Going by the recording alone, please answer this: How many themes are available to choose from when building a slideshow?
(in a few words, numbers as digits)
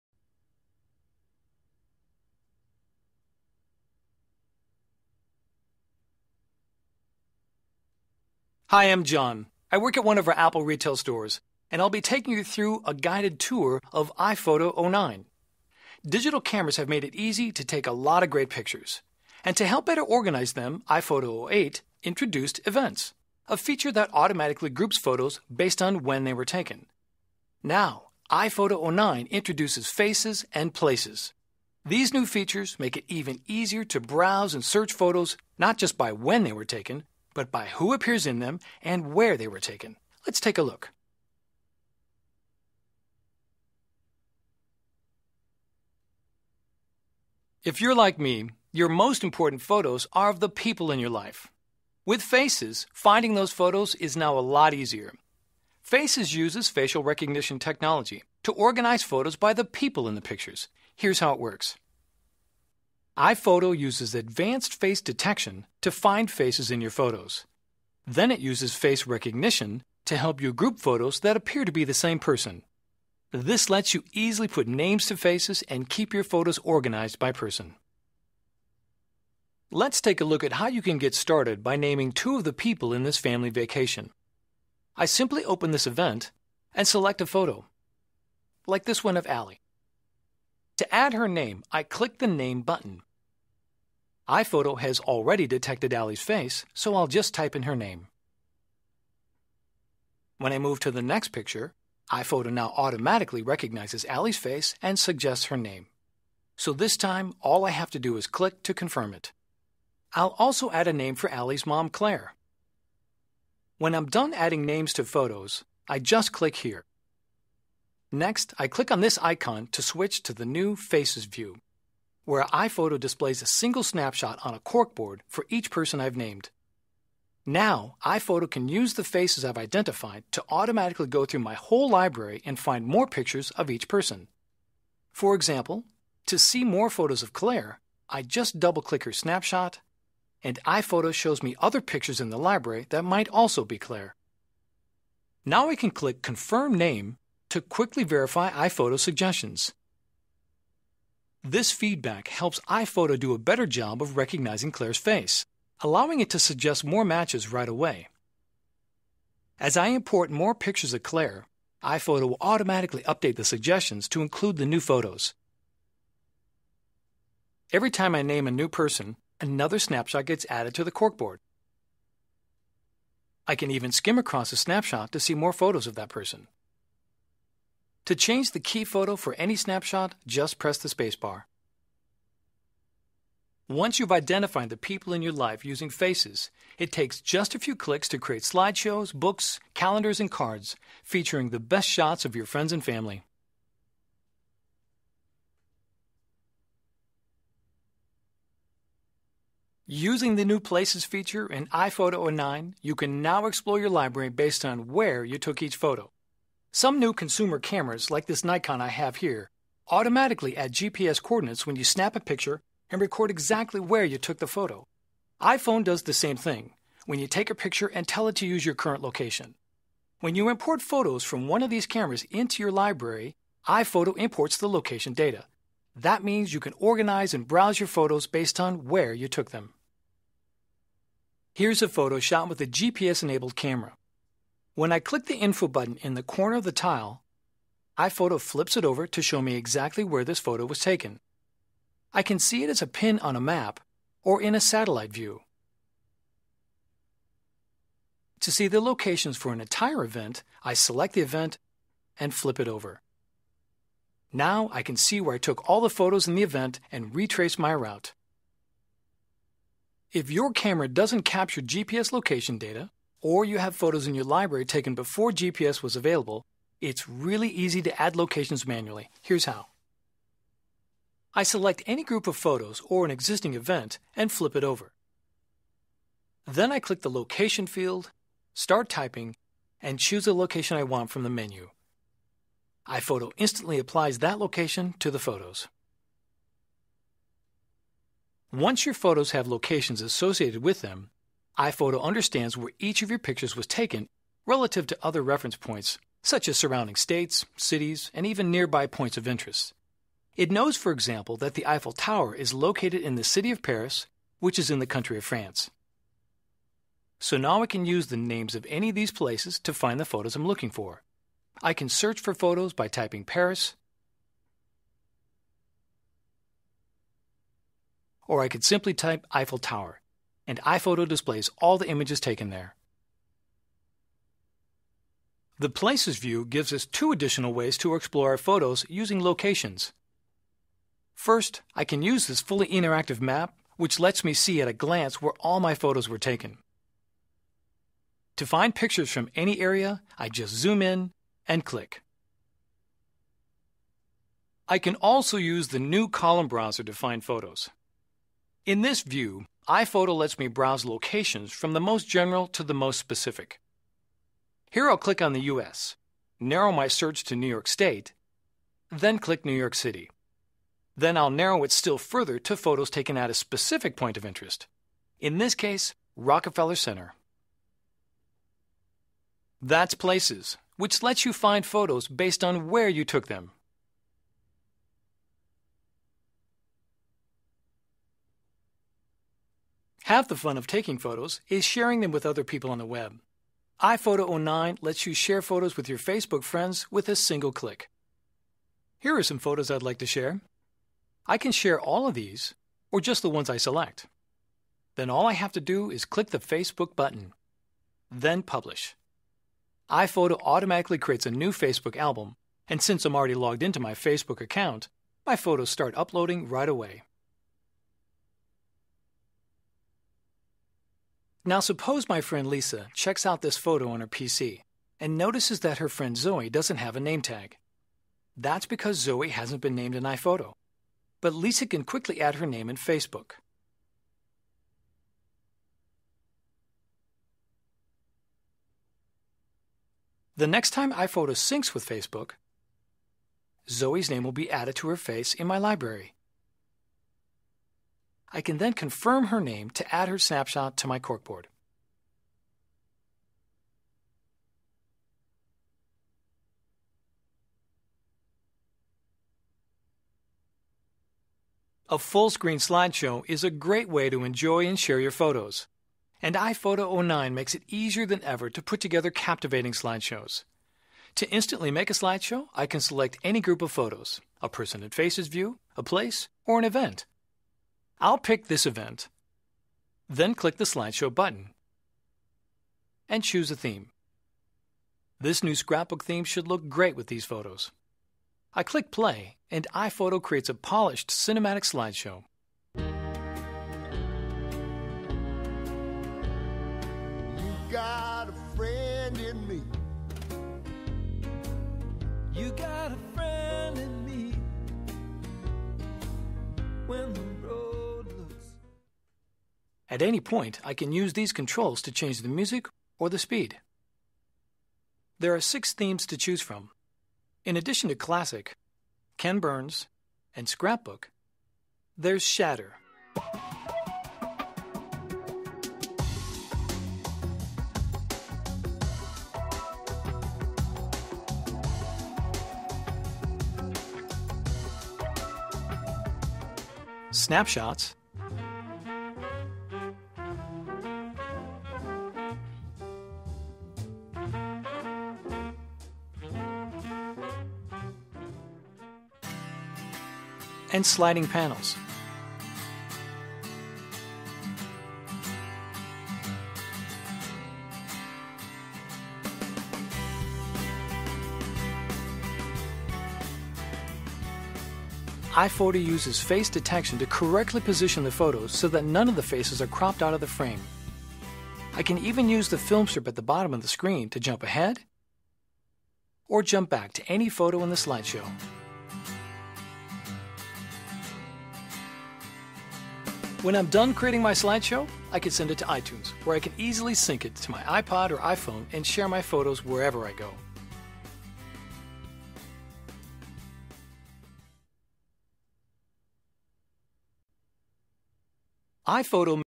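6.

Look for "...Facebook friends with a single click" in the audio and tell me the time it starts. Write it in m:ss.
6:25.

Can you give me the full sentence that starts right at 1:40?
When I move to the next picture, iPhoto now automatically recognizes Allie's face and suggests her name.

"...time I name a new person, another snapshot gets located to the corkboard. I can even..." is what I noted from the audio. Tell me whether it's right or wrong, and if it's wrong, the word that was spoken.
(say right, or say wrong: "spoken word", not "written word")
wrong: "added", not "located".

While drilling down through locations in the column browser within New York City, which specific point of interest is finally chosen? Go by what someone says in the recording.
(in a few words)
Rockefeller Center.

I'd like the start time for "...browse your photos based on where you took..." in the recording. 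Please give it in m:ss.
3:47.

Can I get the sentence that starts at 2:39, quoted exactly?
As I import more pictures of Claire, iPhoto will automatically update the suggestions to include the new photos.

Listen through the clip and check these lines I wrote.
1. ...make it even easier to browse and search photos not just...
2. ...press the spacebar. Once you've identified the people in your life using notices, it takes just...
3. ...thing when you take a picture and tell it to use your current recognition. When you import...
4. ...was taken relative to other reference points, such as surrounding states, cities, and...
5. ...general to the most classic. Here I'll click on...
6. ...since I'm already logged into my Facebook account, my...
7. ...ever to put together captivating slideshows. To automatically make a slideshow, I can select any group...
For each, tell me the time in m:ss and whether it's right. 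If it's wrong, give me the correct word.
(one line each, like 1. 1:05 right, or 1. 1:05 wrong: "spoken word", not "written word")
1. 0:32 right
2. 3:00 wrong: "faces", not "notices"
3. 3:36 wrong: "location", not "recognition"
4. 4:53 right
5. 5:52 wrong: "specific", not "classic"
6. 6:42 right
7. 7:38 wrong: "instantly", not "automatically".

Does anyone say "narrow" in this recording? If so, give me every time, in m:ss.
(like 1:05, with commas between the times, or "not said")
5:56, 6:01.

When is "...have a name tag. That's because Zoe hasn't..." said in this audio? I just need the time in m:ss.
6:56.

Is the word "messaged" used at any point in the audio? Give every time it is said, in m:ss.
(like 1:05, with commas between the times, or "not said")
not said.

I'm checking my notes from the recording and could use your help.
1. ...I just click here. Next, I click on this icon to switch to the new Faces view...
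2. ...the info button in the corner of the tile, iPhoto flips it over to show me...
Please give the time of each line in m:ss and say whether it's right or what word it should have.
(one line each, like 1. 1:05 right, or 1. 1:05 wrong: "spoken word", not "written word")
1. 1:55 right
2. 3:55 right.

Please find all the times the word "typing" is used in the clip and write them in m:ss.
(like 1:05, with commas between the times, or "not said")
4:38, 5:12.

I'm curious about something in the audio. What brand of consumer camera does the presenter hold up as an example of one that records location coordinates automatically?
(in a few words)
Nikon.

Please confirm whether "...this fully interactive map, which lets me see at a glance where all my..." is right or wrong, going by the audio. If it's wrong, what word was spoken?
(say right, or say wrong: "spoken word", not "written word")
right.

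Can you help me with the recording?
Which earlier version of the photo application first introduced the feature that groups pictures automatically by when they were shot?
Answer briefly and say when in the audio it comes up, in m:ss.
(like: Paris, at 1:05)
iPhoto 08, at 0:20.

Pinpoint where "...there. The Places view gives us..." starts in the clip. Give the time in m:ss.
5:22.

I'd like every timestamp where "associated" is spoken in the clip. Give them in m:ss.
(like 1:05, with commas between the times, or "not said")
4:50.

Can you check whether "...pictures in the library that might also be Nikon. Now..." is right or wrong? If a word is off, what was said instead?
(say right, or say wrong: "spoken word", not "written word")
wrong: "Claire", not "Nikon".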